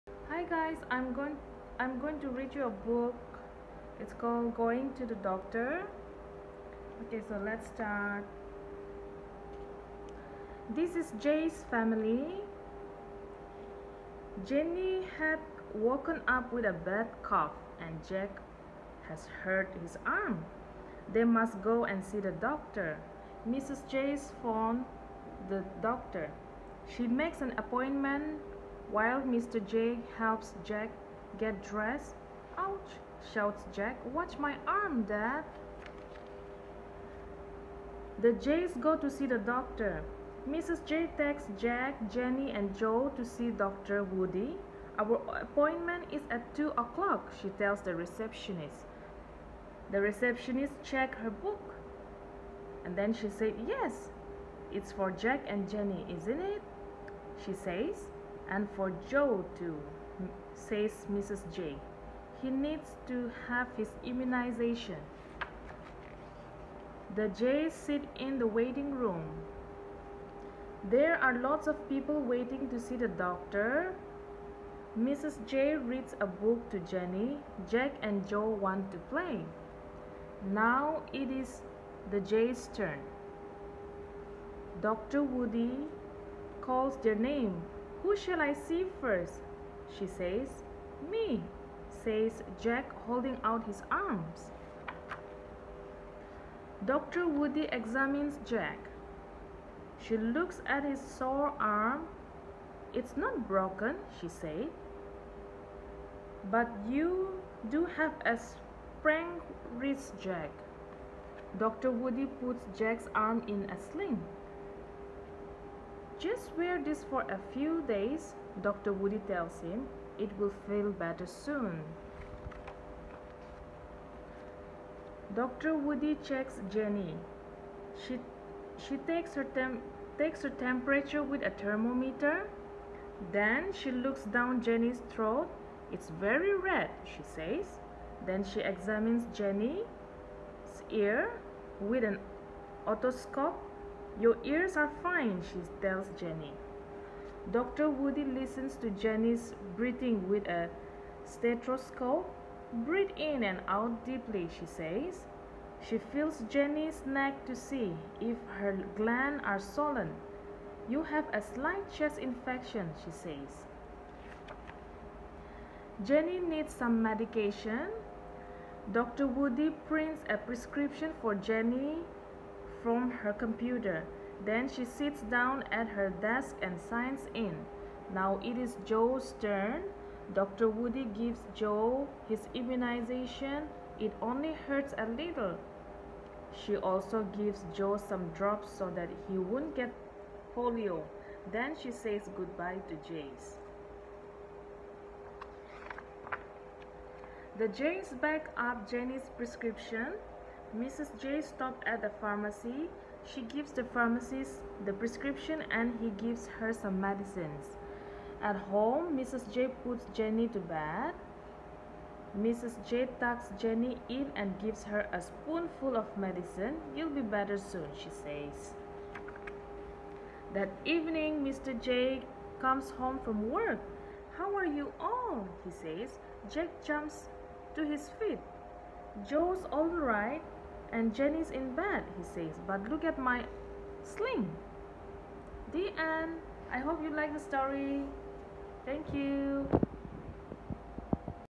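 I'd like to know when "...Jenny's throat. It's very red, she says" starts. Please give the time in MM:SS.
02:14.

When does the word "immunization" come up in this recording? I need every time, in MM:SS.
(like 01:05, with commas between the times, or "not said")
01:04, 03:02.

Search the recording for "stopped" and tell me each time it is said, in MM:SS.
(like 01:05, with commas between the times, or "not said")
03:21.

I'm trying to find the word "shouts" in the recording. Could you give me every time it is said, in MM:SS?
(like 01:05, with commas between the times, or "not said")
00:33.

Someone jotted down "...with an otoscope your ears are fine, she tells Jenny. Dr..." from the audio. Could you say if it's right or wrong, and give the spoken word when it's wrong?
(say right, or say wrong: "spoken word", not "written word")
right.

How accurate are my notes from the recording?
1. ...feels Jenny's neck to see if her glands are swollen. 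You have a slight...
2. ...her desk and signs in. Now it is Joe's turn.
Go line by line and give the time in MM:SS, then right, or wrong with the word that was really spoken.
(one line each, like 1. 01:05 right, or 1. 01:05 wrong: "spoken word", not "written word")
1. 02:35 right
2. 02:55 right.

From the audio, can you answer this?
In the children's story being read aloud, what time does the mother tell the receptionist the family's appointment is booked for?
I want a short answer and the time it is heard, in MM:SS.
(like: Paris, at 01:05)
2 o'clock, at 00:46.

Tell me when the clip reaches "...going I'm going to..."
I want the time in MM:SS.
00:01.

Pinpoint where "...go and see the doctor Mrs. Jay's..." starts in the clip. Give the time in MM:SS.
00:21.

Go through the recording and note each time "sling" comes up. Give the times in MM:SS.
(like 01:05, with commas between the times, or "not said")
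01:53, 03:54.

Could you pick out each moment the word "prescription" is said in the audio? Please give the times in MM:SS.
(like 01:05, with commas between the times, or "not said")
02:50, 03:19, 03:24.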